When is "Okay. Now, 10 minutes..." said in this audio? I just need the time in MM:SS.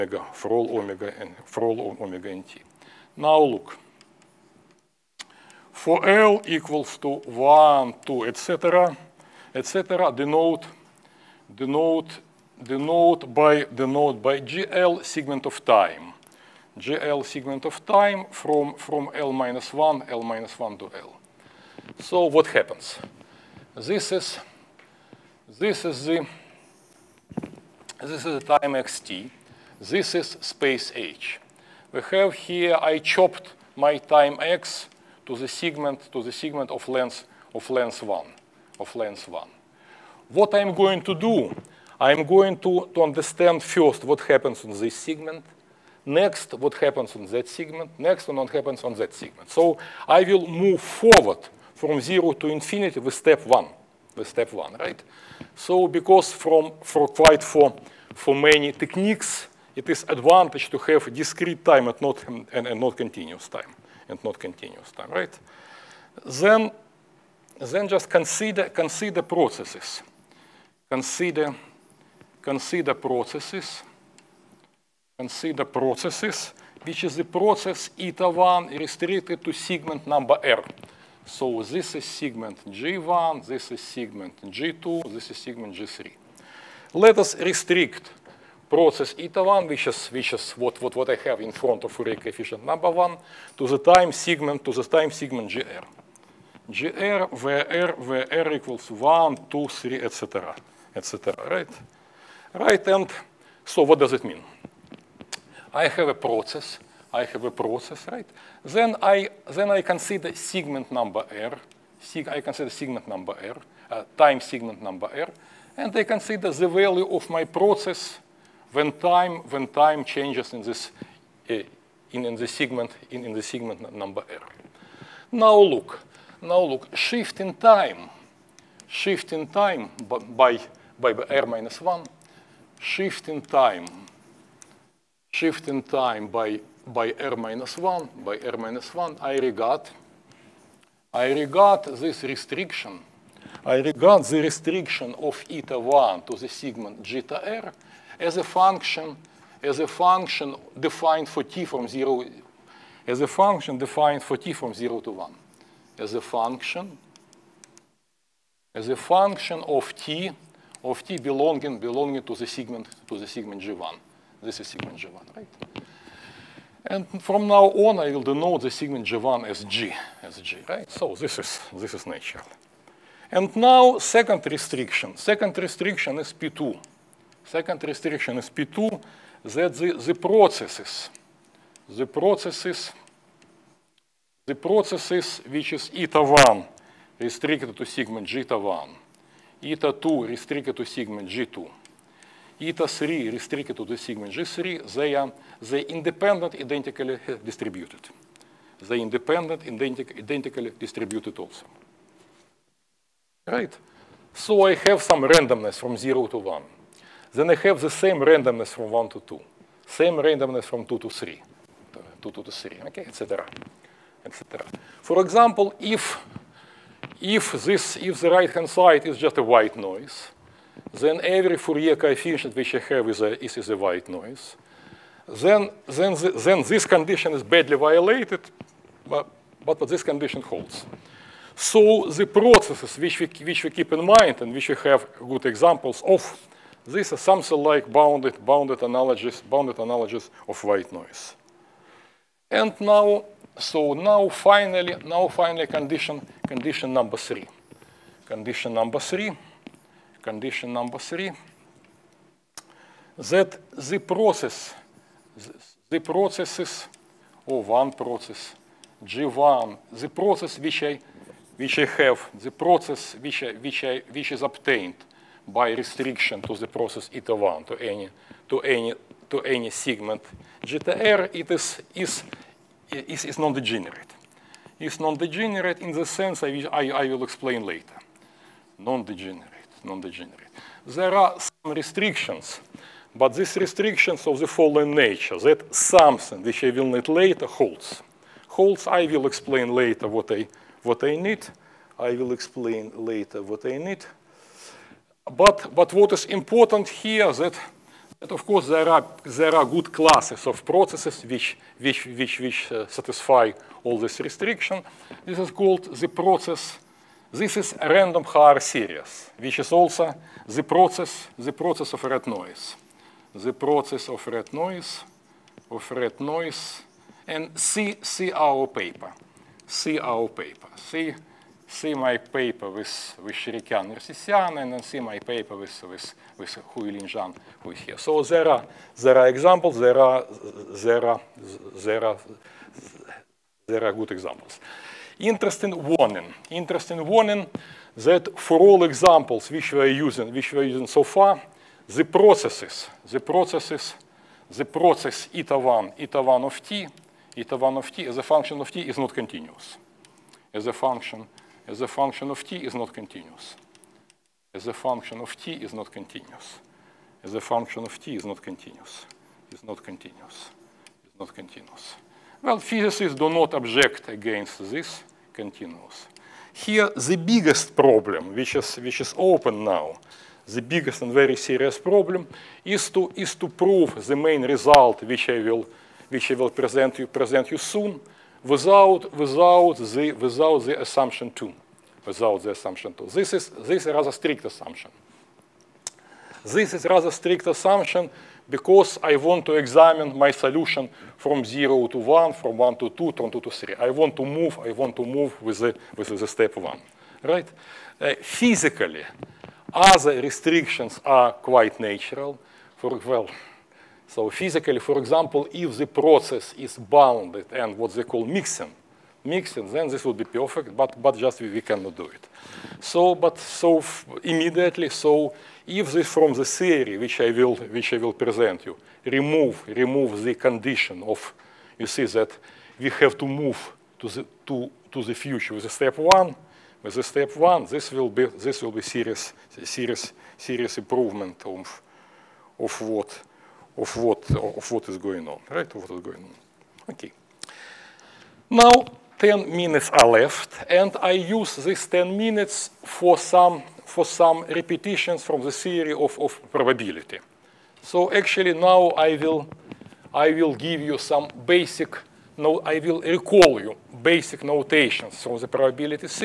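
07:16.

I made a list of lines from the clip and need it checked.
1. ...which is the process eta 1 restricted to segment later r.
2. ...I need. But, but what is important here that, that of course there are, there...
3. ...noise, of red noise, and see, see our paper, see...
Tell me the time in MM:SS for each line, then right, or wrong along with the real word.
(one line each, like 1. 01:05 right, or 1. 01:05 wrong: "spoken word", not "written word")
1. 01:16 wrong: "number", not "later"
2. 04:53 right
3. 05:14 right.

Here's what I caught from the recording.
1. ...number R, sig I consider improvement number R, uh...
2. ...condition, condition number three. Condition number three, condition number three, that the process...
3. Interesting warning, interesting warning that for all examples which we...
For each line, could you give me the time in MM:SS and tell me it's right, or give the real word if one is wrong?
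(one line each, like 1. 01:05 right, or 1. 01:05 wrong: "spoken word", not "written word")
1. 01:50 wrong: "segment", not "improvement"
2. 04:05 right
3. 05:35 right.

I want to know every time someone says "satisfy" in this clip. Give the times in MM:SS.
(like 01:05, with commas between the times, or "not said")
05:02.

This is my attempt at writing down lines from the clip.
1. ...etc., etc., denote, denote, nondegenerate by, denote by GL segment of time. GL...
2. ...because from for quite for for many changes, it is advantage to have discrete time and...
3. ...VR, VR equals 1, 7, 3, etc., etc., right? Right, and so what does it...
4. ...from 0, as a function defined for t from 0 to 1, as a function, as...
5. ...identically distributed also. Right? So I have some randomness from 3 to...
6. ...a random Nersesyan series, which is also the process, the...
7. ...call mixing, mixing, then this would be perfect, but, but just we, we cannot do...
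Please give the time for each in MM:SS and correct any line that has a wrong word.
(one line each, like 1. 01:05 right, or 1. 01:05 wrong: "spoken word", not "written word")
1. 00:08 wrong: "denote", not "nondegenerate"
2. 00:55 wrong: "techniques", not "changes"
3. 01:37 wrong: "2", not "7"
4. 02:31 right
5. 03:20 wrong: "0", not "3"
6. 05:07 wrong: "Haar", not "Nersesyan"
7. 06:48 right.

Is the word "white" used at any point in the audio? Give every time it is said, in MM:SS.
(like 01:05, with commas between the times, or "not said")
03:39, 03:43, 04:00.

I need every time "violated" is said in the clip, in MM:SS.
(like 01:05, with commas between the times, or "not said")
03:47.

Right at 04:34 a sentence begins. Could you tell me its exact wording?
It's non-degenerate in the sense I, will, I, I will explain later.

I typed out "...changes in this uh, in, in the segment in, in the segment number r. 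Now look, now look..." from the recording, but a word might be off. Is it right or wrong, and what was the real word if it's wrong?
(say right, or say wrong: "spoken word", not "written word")
right.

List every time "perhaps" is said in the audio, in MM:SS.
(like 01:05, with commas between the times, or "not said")
not said.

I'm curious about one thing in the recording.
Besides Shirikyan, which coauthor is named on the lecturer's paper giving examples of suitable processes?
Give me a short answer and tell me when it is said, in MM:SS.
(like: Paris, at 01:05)
Nersesyan, at 05:23.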